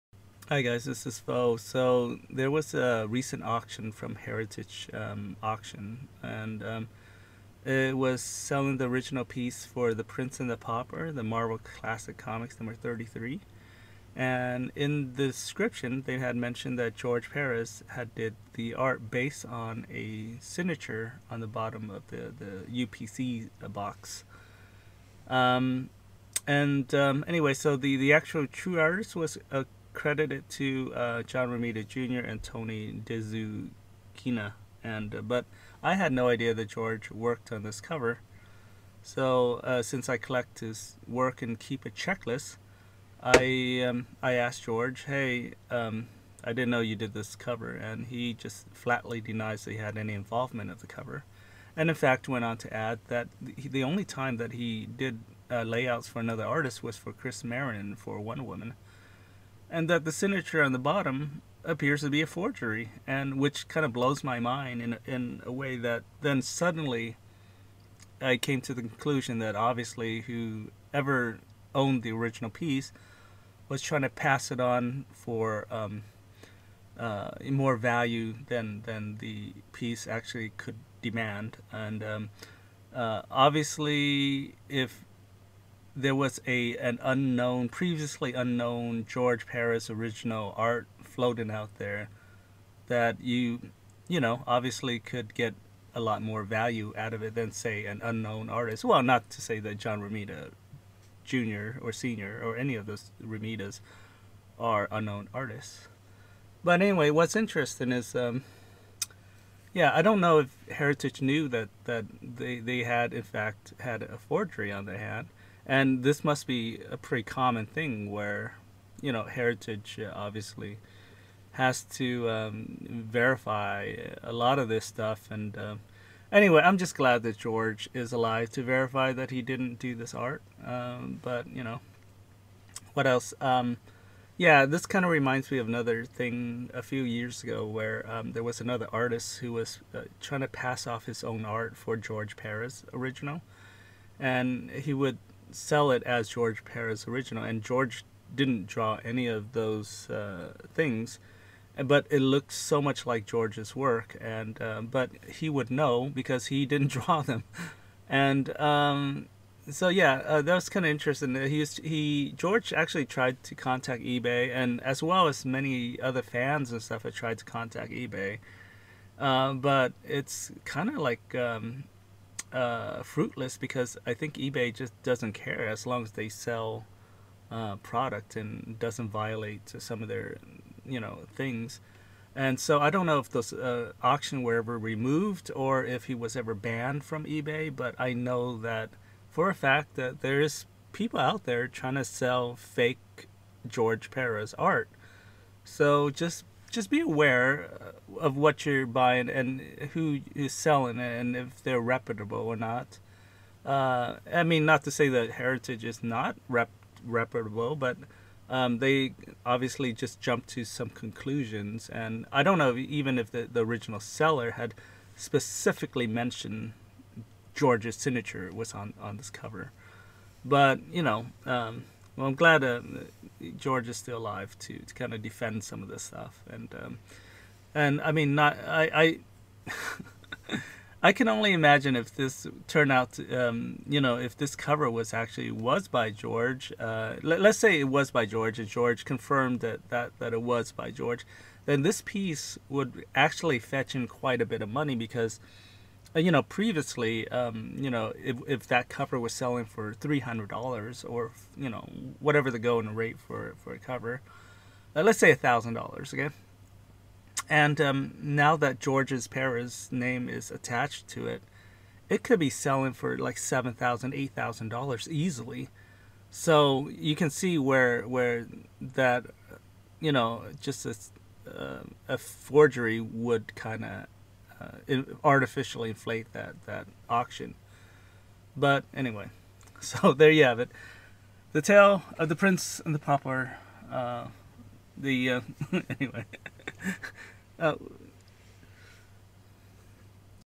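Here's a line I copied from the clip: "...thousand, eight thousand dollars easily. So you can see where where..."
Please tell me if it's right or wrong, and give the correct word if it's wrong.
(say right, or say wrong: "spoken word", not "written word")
right.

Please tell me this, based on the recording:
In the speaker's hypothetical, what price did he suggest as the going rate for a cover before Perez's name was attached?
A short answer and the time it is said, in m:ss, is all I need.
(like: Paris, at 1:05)
$1,000, at 4:15.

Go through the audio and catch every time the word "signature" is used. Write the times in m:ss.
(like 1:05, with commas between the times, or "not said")
0:20, 1:00, 3:37.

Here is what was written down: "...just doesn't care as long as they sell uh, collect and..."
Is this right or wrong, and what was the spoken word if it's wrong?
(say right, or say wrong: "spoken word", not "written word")
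wrong: "product", not "collect".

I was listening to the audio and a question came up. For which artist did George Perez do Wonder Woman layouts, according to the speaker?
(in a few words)
Chris Marrinan.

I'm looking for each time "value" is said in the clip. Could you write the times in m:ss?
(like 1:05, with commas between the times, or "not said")
1:17, 1:36.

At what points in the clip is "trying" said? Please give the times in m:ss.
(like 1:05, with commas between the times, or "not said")
1:13, 2:20, 3:11.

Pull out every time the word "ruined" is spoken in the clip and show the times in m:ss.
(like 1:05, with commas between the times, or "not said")
not said.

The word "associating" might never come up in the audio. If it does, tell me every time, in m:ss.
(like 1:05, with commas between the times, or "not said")
not said.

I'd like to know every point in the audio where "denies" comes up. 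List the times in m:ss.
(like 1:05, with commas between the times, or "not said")
0:49.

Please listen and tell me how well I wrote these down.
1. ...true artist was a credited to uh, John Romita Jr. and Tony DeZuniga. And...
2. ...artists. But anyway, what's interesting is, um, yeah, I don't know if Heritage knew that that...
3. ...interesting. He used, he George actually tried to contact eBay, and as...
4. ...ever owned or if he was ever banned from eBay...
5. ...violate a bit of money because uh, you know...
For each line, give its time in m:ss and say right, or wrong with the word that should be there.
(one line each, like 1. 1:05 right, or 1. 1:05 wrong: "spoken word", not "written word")
1. 0:28 right
2. 1:45 right
3. 2:40 right
4. 3:04 wrong: "removed", not "owned"
5. 4:04 wrong: "quite", not "violate".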